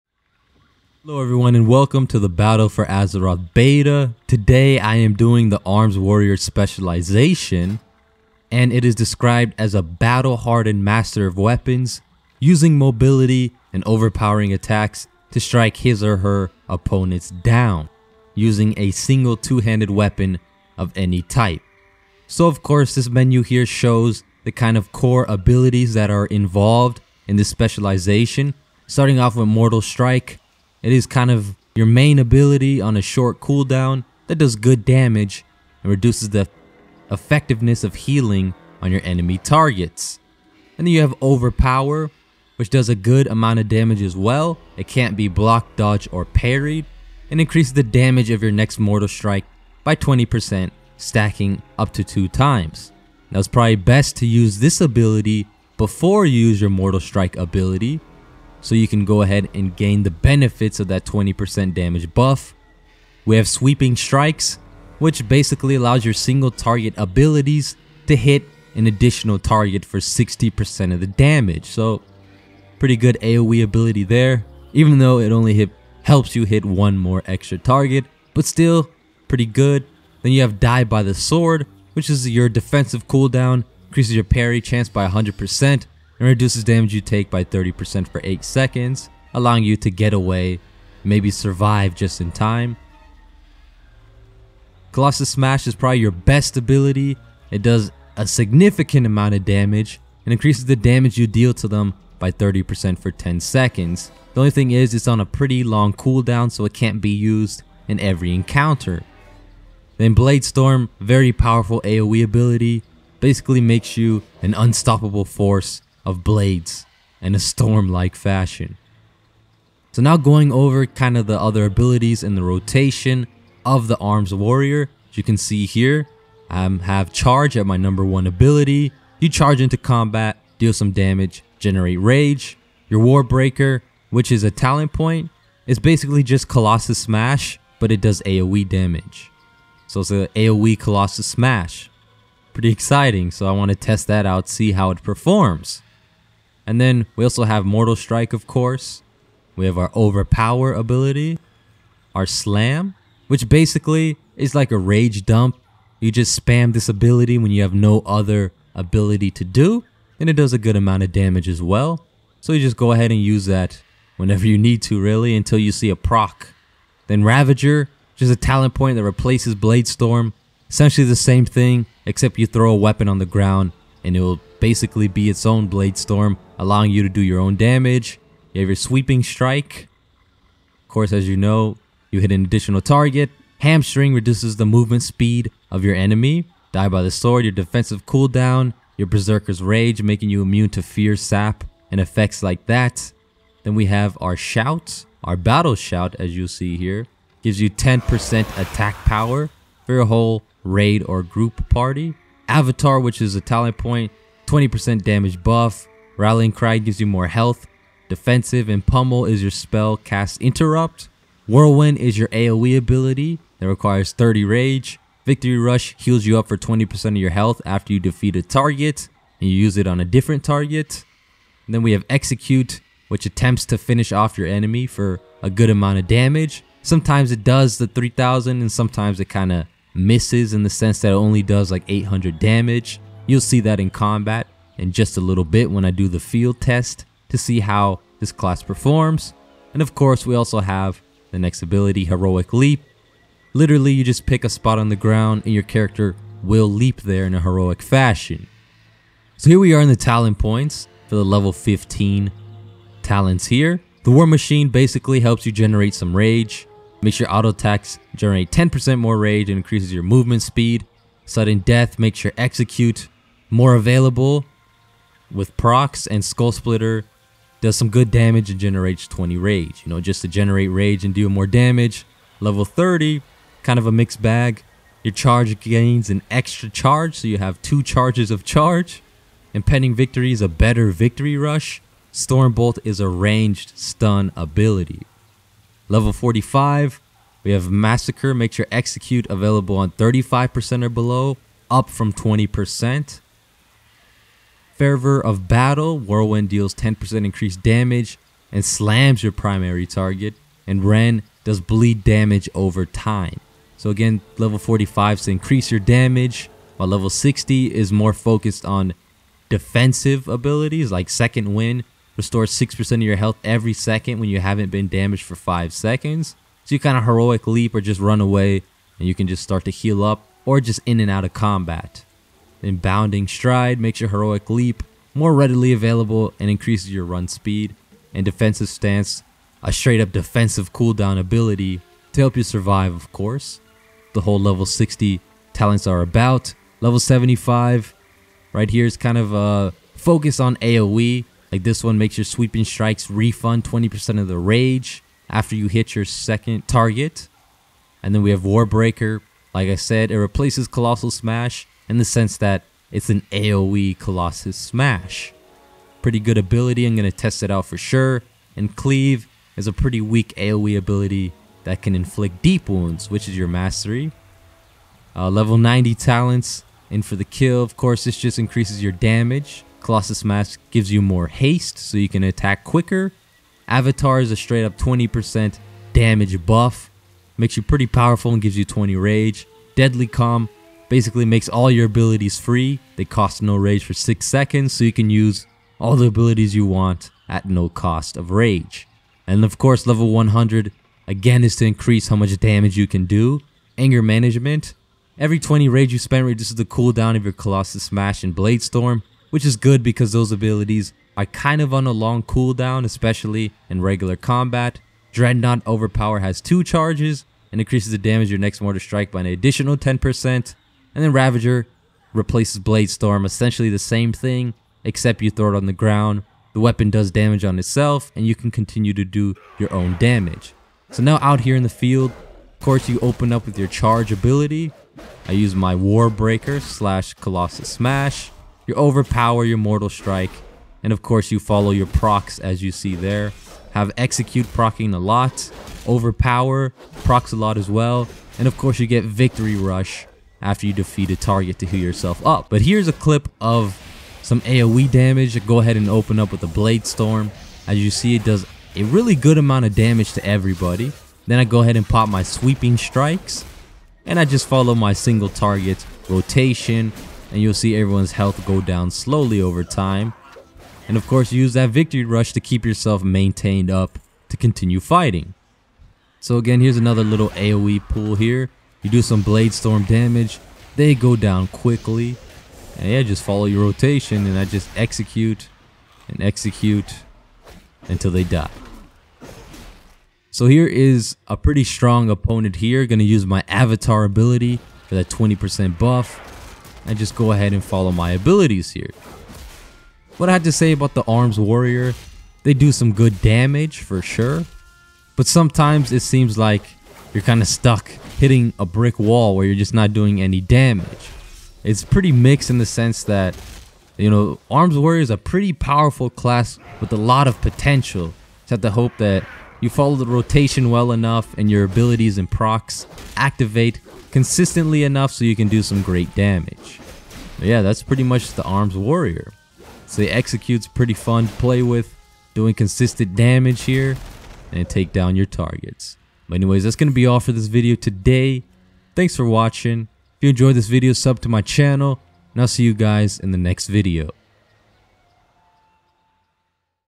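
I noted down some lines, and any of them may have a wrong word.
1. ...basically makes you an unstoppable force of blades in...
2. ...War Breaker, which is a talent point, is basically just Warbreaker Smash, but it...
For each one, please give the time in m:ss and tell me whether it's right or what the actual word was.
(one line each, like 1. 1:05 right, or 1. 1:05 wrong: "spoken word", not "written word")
1. 1:53 right
2. 2:13 wrong: "Colossus", not "Warbreaker".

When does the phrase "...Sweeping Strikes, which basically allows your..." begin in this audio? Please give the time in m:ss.
1:03.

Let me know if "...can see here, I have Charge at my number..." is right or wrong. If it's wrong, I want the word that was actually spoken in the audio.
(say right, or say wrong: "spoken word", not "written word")
right.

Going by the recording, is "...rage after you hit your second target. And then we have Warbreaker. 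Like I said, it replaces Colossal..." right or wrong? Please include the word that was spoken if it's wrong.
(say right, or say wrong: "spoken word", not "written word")
right.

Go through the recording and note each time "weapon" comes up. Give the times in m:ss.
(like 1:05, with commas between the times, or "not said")
0:11, 0:19, 2:52, 6:56.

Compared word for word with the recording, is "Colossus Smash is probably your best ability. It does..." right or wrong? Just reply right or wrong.
right.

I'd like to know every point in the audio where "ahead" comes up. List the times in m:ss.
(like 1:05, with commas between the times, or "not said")
0:59, 2:42, 7:25, 7:31, 8:07.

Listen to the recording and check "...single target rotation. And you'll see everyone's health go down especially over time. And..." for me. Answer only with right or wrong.
wrong.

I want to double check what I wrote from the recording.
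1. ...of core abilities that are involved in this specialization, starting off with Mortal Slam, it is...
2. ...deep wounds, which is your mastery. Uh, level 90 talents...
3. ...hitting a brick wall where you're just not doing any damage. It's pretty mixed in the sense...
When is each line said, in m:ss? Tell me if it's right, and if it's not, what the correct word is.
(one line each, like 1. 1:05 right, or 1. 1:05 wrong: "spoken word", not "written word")
1. 0:24 wrong: "Strike", not "Slam"
2. 6:02 right
3. 8:18 right.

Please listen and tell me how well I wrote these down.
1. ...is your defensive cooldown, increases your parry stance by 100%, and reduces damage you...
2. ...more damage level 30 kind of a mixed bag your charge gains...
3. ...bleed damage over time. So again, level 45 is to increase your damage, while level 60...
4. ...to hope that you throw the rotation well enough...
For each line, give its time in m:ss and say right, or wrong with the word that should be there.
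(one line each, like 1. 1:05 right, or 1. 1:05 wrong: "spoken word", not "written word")
1. 1:22 wrong: "chance", not "stance"
2. 4:31 right
3. 5:01 right
4. 8:28 wrong: "follow", not "throw".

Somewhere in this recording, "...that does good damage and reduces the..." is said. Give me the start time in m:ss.
0:34.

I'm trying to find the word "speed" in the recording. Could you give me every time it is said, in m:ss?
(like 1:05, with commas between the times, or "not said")
3:05, 4:20, 5:27.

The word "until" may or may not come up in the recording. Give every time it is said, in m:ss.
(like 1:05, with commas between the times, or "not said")
2:45, 7:57.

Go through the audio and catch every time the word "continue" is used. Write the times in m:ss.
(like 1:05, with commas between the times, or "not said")
6:58, 7:44.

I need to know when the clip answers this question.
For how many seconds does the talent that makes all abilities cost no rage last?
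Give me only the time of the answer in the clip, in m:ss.
6:23.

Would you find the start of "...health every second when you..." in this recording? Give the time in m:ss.
5:13.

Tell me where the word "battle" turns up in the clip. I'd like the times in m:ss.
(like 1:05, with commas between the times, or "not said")
0:02, 0:09, 3:15, 4:55.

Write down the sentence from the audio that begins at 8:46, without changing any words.
But anyways, that's going to be all for this video today.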